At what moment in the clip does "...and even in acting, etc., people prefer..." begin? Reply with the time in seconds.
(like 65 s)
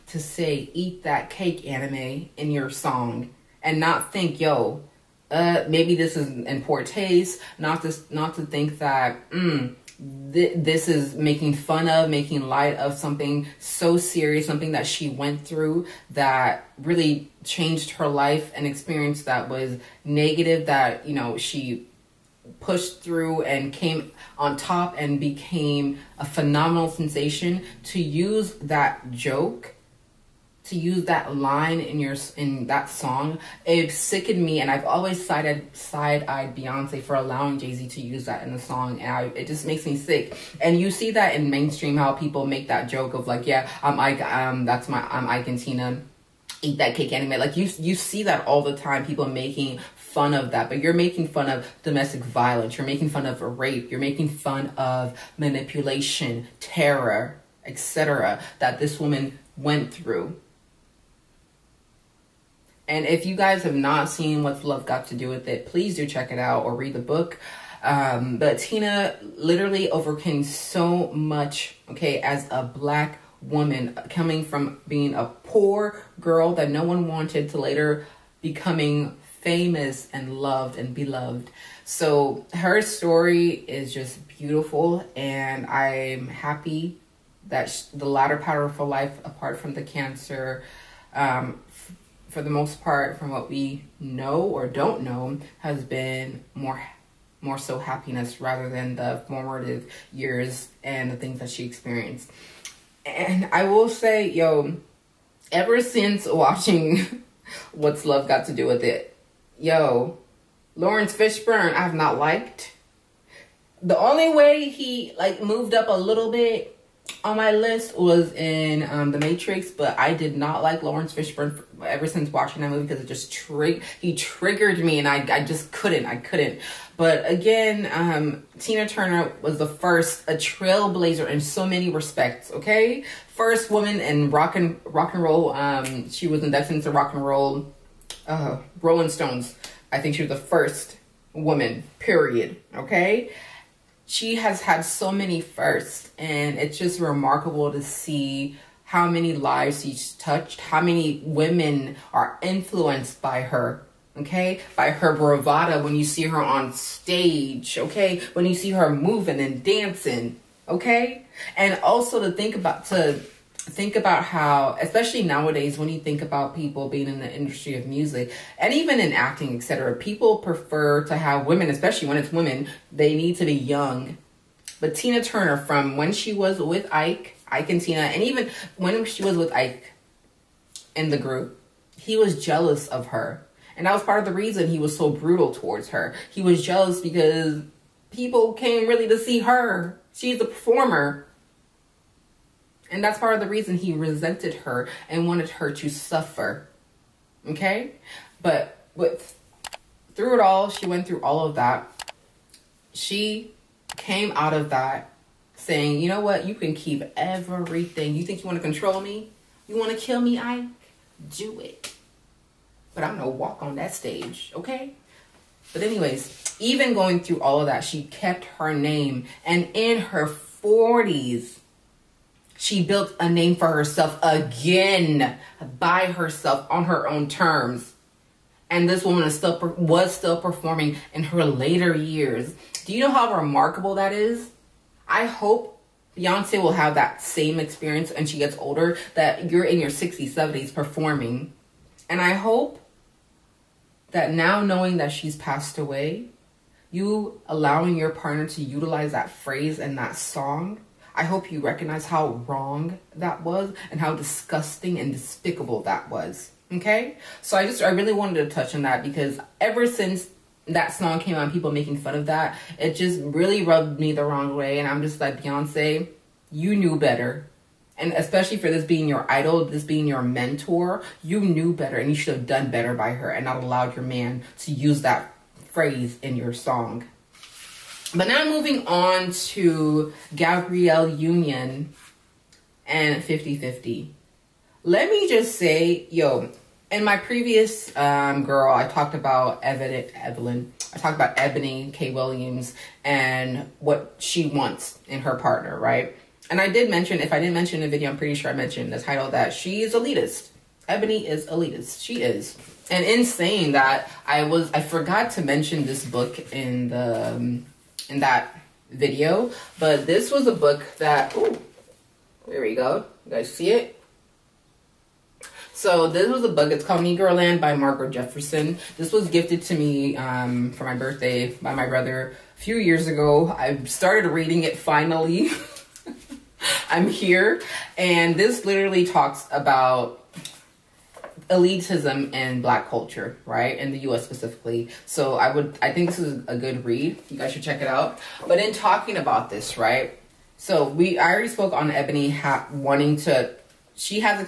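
168 s.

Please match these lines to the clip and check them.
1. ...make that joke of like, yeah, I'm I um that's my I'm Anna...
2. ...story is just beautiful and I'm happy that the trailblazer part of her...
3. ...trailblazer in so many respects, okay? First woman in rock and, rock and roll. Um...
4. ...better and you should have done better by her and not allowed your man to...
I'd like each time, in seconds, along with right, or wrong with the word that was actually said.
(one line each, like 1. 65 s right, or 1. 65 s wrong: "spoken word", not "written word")
1. 42 s wrong: "Ike", not "Anna"
2. 82 s wrong: "latter", not "trailblazer"
3. 130 s right
4. 271 s right.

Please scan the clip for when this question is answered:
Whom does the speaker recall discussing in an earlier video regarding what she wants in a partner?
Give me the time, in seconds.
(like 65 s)
291 s.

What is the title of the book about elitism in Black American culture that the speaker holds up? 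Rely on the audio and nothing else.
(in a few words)
Negroland.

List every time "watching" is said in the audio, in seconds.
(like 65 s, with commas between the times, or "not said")
106 s, 122 s.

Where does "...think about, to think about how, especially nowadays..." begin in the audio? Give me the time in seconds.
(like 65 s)
162 s.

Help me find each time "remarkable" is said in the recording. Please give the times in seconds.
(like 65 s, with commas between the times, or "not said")
146 s, 233 s.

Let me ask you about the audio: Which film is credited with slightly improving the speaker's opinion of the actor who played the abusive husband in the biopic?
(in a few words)
The Matrix.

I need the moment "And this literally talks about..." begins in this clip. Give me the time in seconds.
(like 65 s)
327 s.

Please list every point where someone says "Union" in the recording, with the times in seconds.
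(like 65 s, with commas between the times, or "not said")
281 s.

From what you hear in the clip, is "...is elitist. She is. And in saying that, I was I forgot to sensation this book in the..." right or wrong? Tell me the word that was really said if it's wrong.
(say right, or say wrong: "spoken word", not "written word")
wrong: "mention", not "sensation".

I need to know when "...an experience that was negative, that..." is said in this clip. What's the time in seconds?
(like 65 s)
18 s.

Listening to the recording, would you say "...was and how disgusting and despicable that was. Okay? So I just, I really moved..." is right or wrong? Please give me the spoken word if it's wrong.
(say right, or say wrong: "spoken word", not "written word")
wrong: "wanted", not "moved".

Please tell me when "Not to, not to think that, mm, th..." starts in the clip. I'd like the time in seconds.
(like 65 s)
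7 s.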